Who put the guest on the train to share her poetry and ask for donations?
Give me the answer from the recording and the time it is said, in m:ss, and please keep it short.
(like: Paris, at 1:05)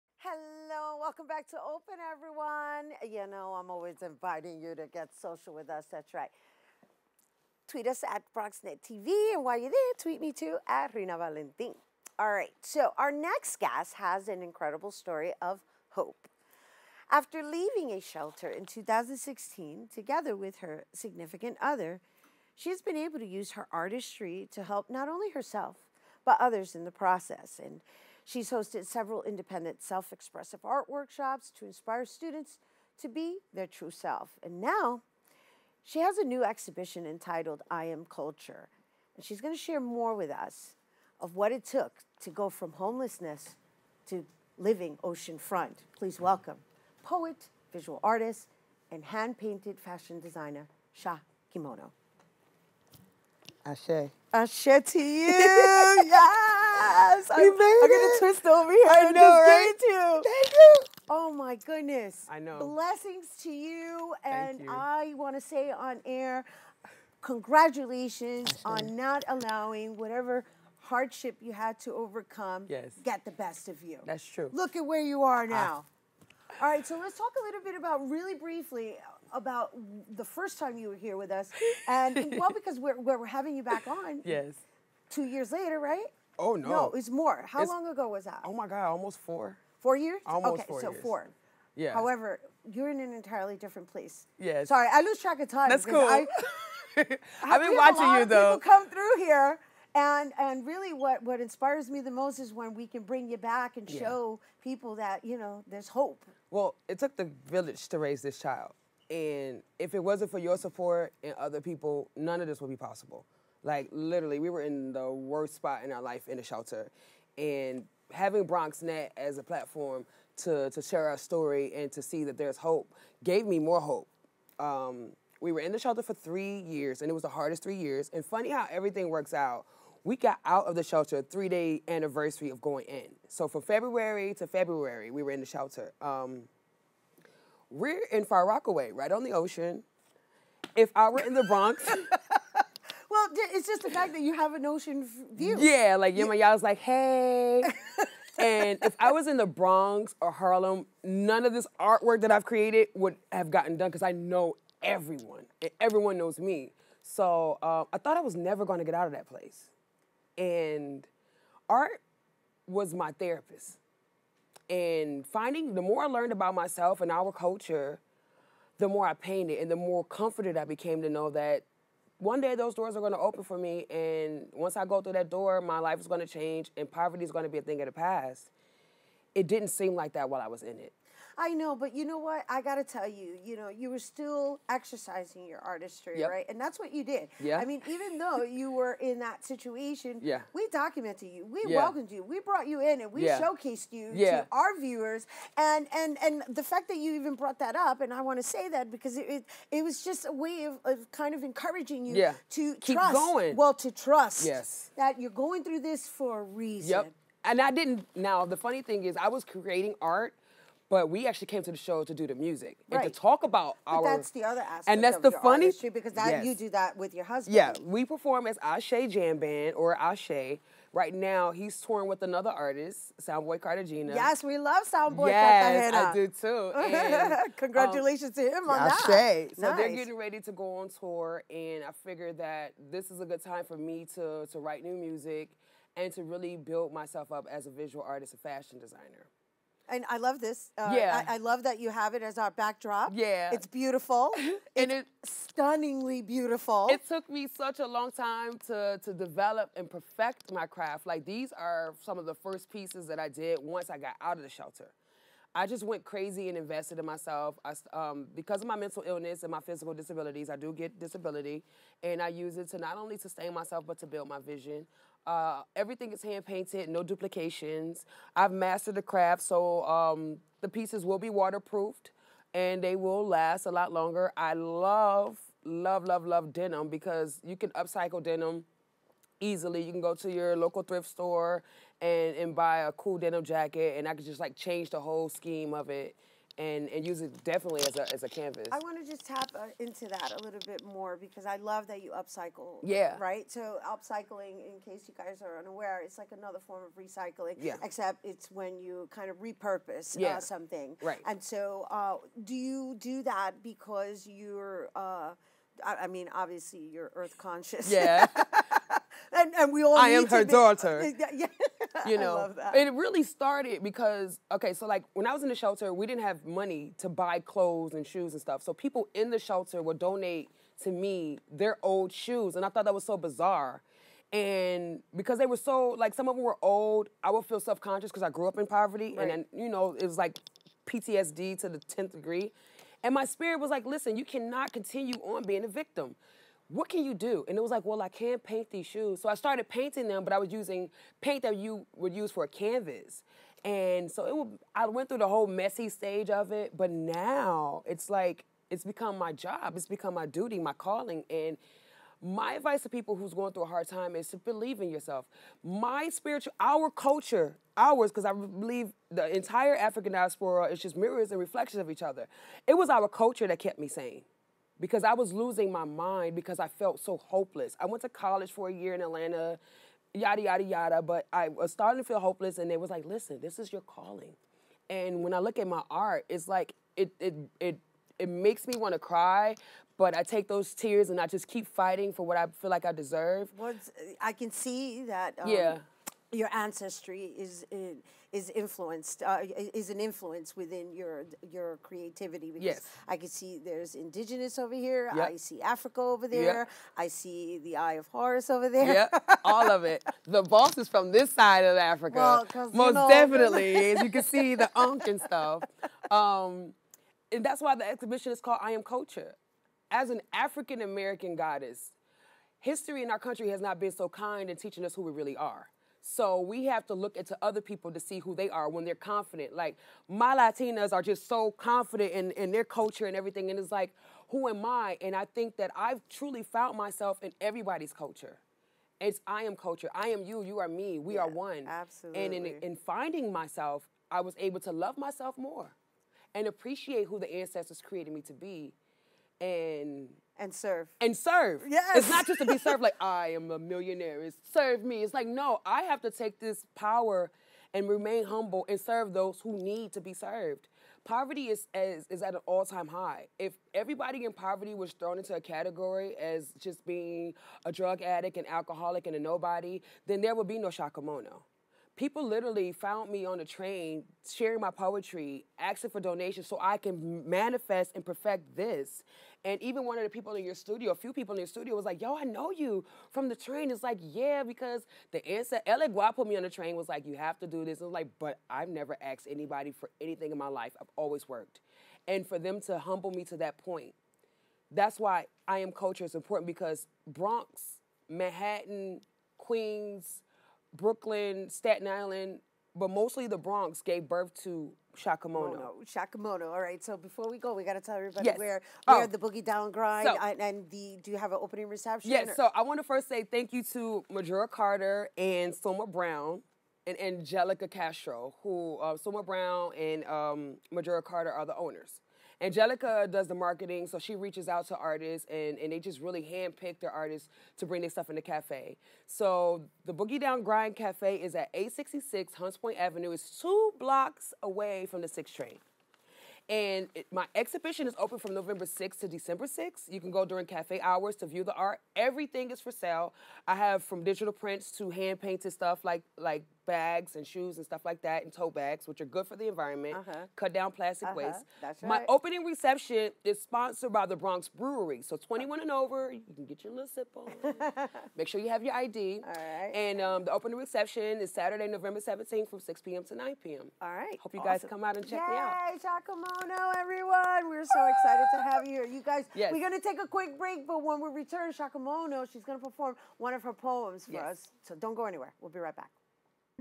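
Ella Guap, at 7:55.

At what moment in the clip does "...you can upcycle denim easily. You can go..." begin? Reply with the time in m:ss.
4:37.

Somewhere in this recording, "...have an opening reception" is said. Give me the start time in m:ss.
8:21.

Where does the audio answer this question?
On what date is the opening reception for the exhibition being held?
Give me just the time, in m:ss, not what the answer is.
9:11.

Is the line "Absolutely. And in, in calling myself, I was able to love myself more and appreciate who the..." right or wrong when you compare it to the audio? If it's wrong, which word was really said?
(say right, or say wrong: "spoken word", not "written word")
wrong: "finding", not "calling".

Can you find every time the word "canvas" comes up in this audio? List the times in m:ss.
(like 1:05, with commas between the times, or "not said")
4:48, 5:42.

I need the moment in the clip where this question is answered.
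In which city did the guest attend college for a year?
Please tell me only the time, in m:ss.
6:09.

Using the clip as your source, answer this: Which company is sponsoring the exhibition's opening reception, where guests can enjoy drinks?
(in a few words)
Bronx Brewery.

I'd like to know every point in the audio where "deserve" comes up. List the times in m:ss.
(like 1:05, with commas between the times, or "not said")
6:22.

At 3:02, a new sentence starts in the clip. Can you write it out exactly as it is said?
I got to tell you, you know, you were still exercising your artistry, yep.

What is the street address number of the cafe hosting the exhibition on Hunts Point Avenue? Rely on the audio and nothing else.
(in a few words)
866.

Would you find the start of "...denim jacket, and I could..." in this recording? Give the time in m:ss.
4:43.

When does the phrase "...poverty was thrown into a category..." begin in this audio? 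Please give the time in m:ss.
7:34.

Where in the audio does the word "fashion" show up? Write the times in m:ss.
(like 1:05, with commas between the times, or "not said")
0:49, 3:58.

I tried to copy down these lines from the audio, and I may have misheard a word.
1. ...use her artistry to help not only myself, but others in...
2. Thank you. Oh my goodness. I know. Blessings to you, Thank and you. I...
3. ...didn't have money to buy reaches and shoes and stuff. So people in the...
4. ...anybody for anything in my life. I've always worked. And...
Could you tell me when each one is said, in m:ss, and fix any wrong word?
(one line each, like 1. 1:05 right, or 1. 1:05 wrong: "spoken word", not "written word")
1. 0:23 wrong: "herself", not "myself"
2. 1:00 right
3. 5:16 wrong: "clothes", not "reaches"
4. 7:59 right.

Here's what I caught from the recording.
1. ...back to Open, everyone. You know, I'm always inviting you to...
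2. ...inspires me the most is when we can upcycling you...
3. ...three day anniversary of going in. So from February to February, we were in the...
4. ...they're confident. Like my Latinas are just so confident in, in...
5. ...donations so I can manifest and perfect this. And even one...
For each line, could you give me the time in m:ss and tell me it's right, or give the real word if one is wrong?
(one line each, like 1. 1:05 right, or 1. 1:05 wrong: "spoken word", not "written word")
1. 0:01 right
2. 1:41 wrong: "bring", not "upcycling"
3. 2:11 right
4. 6:58 right
5. 7:45 right.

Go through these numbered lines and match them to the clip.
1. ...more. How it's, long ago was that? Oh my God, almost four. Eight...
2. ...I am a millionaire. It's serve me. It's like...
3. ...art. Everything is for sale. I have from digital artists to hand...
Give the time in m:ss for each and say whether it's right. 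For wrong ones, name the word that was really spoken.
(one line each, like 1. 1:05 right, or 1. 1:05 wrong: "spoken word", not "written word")
1. 1:27 wrong: "Four", not "Eight"
2. 7:22 right
3. 8:51 wrong: "prints", not "artists".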